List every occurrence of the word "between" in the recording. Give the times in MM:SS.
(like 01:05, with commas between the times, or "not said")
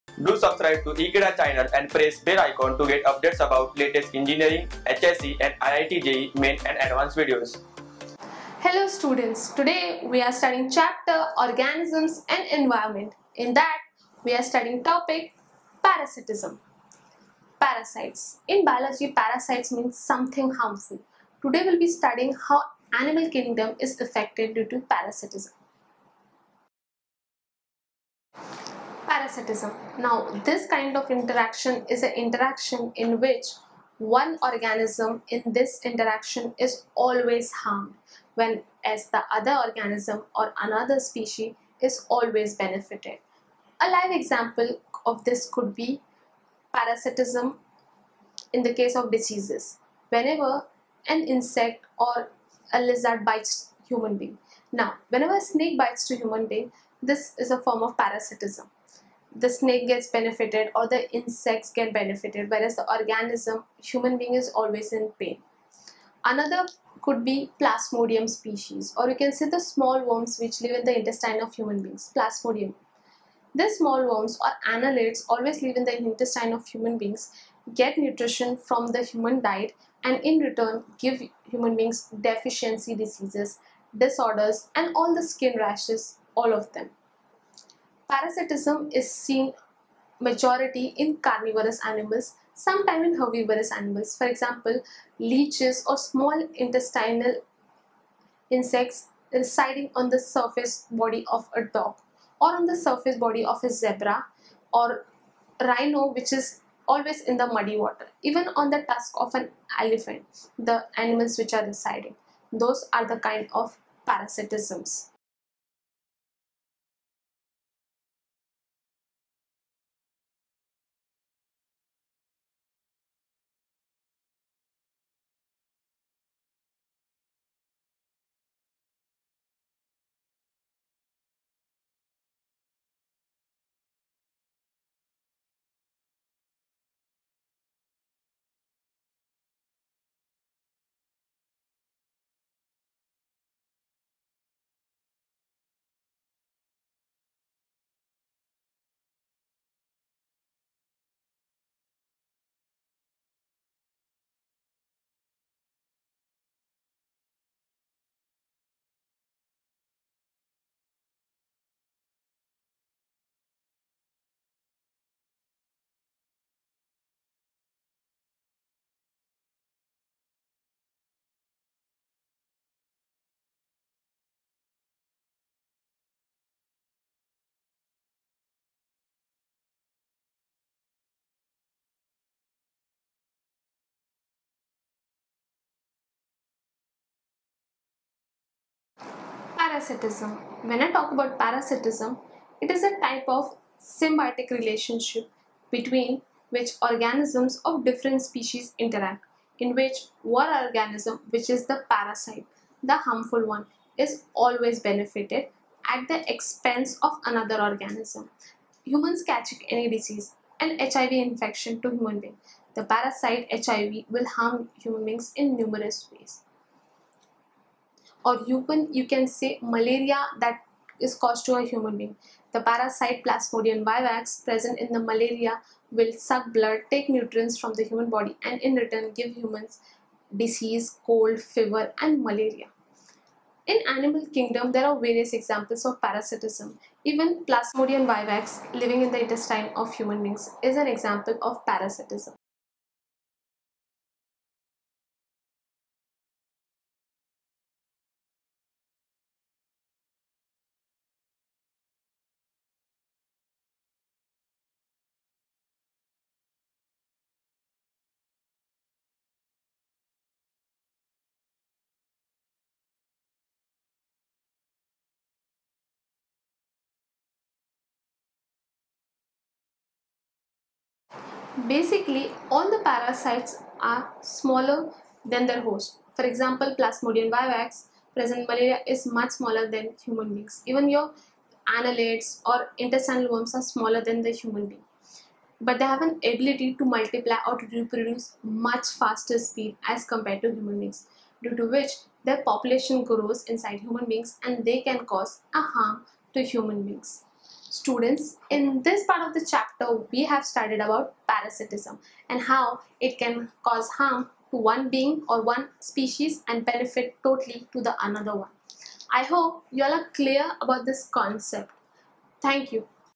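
03:15.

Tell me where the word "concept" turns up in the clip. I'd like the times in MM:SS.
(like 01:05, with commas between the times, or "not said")
05:11.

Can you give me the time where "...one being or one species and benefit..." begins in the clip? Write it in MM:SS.
05:04.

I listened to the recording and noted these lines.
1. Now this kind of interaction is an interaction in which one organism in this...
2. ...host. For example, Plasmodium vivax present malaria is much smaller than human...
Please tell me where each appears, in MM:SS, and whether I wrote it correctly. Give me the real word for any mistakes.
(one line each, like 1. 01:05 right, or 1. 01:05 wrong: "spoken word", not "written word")
1. 00:29 right
2. 04:35 right.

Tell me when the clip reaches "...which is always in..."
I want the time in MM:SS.
01:46.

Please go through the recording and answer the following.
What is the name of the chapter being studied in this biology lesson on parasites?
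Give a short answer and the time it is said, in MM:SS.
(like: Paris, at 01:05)
Organisms and Environment, at 00:11.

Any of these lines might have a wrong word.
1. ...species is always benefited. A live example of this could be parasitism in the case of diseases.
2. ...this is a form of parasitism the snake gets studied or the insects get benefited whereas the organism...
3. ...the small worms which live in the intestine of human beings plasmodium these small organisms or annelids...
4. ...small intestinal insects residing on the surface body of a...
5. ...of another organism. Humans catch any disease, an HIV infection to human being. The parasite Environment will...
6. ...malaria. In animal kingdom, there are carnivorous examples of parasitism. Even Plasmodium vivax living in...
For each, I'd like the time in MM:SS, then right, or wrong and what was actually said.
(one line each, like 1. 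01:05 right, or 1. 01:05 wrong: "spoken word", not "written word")
1. 00:40 right
2. 00:57 wrong: "benefited", not "studied"
3. 01:09 wrong: "worms", not "organisms"
4. 01:35 right
5. 03:27 wrong: "HIV", not "Environment"
6. 03:52 wrong: "various", not "carnivorous".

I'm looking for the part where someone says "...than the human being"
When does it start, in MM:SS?
04:44.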